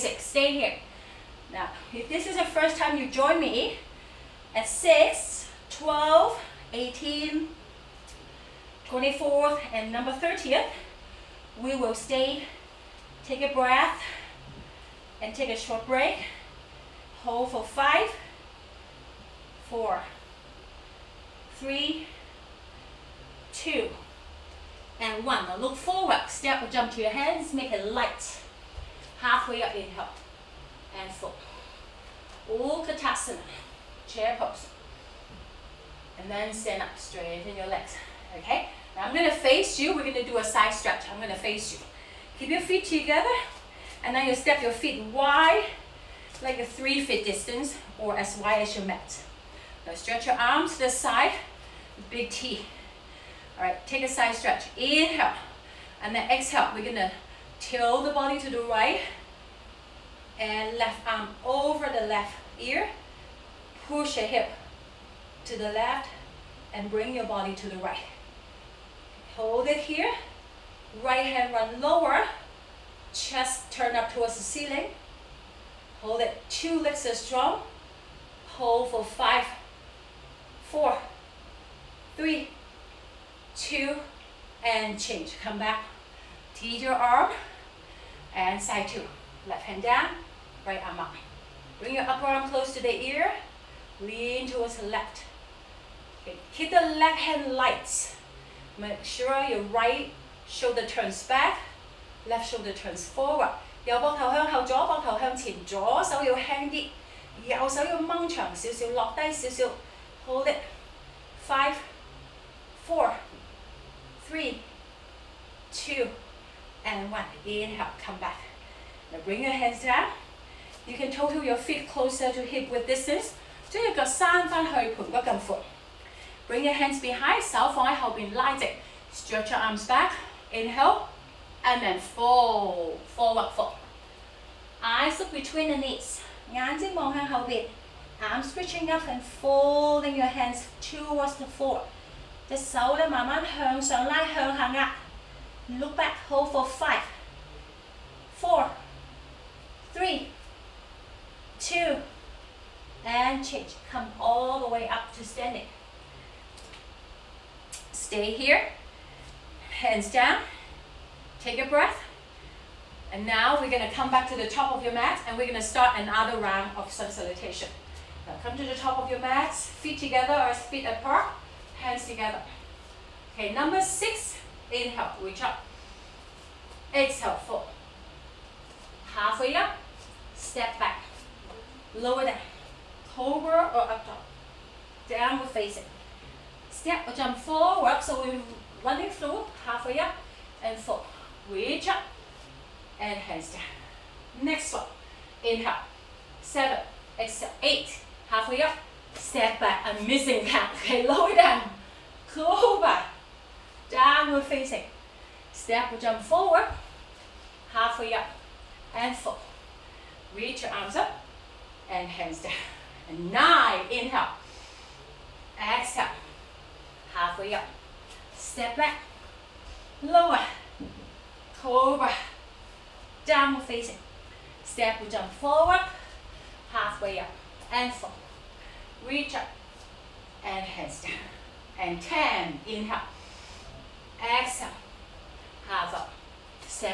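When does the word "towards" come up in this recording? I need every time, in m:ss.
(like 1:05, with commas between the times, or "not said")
1:14, 1:34, 2:20.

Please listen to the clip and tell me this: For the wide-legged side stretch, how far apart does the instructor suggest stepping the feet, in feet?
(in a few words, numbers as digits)
3 feet.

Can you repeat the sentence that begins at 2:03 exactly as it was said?
So you've distance， 將 隻 腳 伸 翻 去 盤 骨 咁 闊。 Bring your hands behind, light Stretch your arms back.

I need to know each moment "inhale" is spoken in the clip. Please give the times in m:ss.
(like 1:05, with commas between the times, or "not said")
0:29, 0:54, 1:57, 2:10, 2:54, 3:15, 3:33, 3:52.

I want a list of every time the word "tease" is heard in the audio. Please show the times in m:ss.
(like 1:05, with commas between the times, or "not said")
1:26.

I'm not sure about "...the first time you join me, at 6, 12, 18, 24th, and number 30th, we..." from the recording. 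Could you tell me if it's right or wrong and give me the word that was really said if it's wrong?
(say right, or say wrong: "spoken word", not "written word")
right.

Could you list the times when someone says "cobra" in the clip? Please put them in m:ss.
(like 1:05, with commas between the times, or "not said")
3:41.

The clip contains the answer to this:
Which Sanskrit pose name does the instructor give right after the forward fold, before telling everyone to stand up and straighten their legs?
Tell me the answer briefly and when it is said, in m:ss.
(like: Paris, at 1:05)
Utkatasana, at 0:32.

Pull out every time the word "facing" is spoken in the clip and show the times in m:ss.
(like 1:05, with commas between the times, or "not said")
3:05, 3:24, 3:43.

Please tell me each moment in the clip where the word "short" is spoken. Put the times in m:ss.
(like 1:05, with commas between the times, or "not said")
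0:15.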